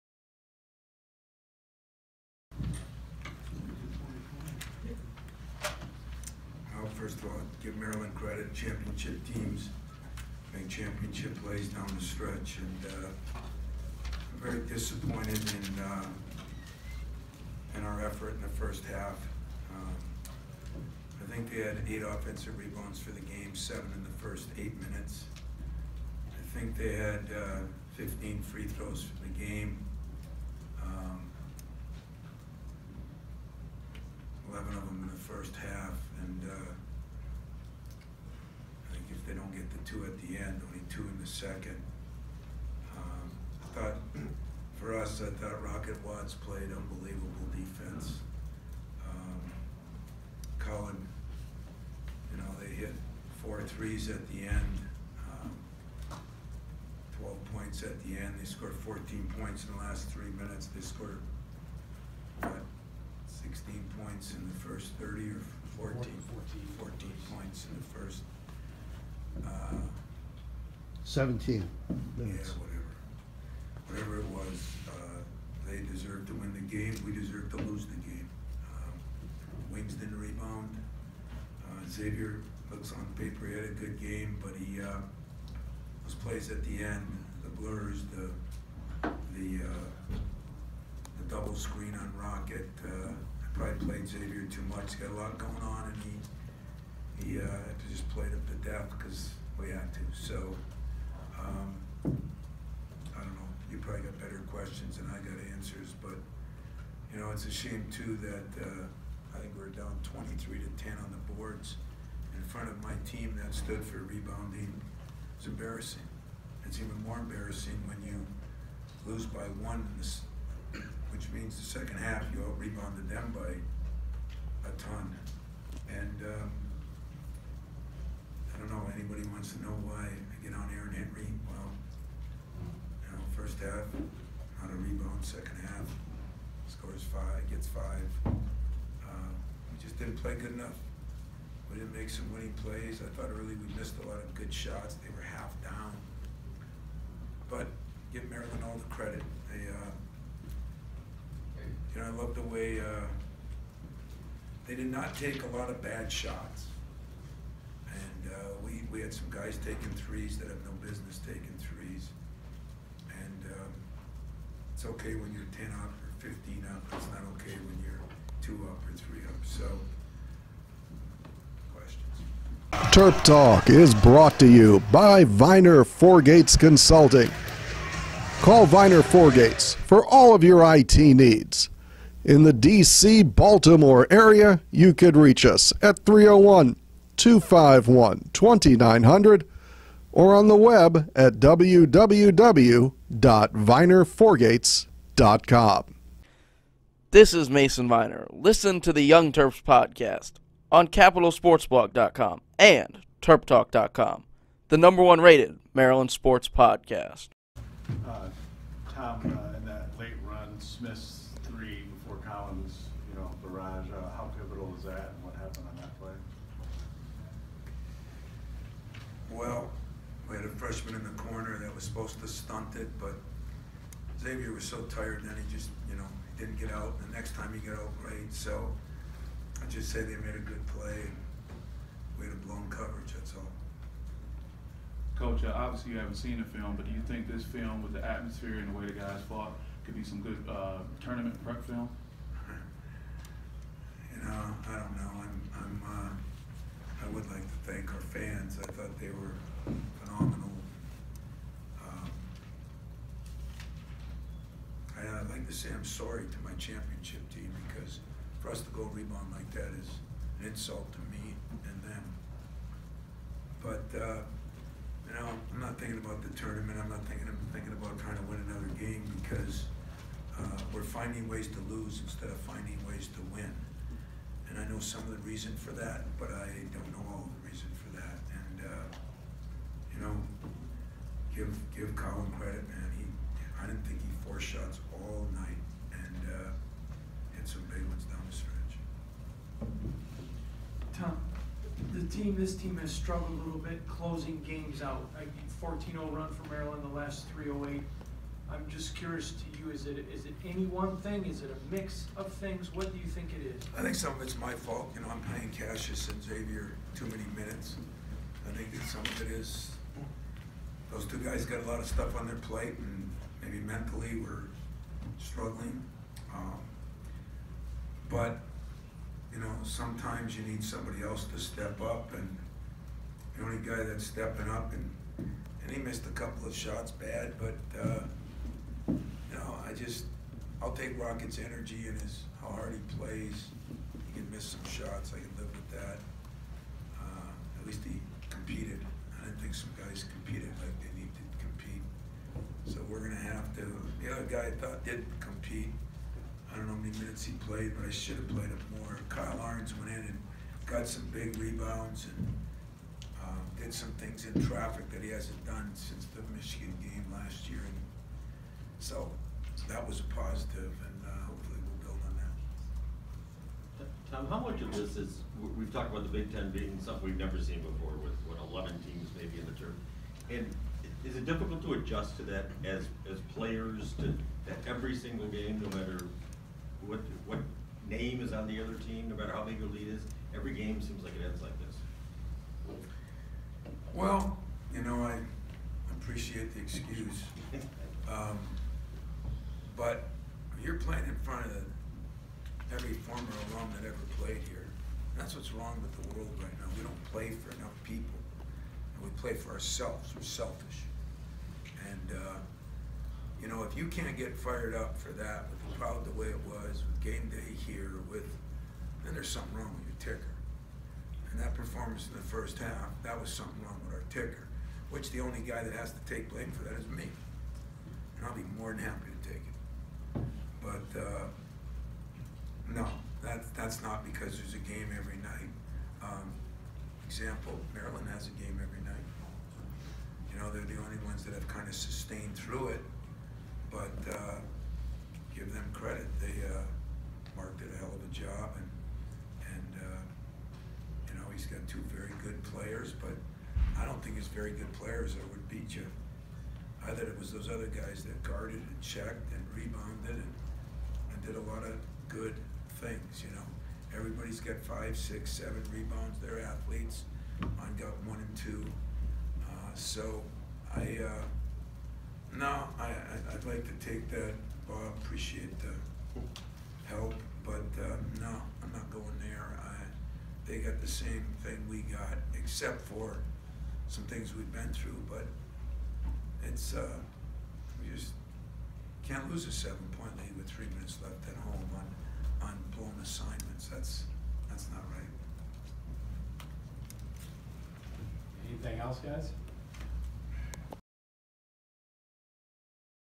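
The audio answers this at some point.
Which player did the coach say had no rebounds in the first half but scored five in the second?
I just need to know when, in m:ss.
2:10.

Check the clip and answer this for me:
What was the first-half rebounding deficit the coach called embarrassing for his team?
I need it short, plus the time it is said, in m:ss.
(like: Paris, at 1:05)
23 to 10, at 1:50.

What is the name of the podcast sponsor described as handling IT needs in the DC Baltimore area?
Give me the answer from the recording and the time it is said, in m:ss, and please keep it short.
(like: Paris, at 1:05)
Viener Four Gates Consulting, at 2:55.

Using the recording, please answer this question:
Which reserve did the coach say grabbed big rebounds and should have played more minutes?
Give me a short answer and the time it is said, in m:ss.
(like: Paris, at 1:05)
Kyle Ahrens, at 5:49.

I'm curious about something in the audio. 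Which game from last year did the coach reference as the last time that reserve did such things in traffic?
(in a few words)
Michigan.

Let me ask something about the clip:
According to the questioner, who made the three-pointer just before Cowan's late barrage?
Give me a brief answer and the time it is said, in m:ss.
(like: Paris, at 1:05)
Smith, at 3:30.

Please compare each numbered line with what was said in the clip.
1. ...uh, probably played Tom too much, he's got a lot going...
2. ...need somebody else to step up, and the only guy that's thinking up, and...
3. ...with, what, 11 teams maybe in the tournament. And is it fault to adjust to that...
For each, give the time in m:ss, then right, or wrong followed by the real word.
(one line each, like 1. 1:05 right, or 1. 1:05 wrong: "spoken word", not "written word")
1. 1:32 wrong: "Xavier", not "Tom"
2. 5:20 wrong: "stepping", not "thinking"
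3. 6:08 wrong: "difficult", not "fault".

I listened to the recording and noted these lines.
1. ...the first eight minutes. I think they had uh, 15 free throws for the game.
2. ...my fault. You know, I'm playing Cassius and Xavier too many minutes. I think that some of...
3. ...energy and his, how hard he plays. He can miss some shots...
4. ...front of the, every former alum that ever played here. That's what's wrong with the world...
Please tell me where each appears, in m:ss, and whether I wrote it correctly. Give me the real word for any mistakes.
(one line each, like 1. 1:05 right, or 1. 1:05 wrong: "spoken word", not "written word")
1. 0:24 right
2. 5:04 right
3. 5:31 right
4. 6:31 right.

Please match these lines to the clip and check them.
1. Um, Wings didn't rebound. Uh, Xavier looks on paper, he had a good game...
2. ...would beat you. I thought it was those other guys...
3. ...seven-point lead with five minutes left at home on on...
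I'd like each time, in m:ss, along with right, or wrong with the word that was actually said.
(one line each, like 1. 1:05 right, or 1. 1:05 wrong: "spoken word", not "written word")
1. 1:18 right
2. 7:25 right
3. 7:59 wrong: "three", not "five".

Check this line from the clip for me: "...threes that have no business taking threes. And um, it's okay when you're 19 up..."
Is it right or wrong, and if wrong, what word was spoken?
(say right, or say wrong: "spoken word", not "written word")
wrong: "10", not "19".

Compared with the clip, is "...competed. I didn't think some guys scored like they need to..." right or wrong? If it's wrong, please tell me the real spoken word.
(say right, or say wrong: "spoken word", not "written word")
wrong: "competed", not "scored".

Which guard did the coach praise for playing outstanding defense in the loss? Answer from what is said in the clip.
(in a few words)
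Rocket Watts.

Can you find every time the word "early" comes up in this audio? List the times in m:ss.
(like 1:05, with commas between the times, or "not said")
2:23.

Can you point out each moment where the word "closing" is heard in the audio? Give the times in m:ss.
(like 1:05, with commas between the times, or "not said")
4:53.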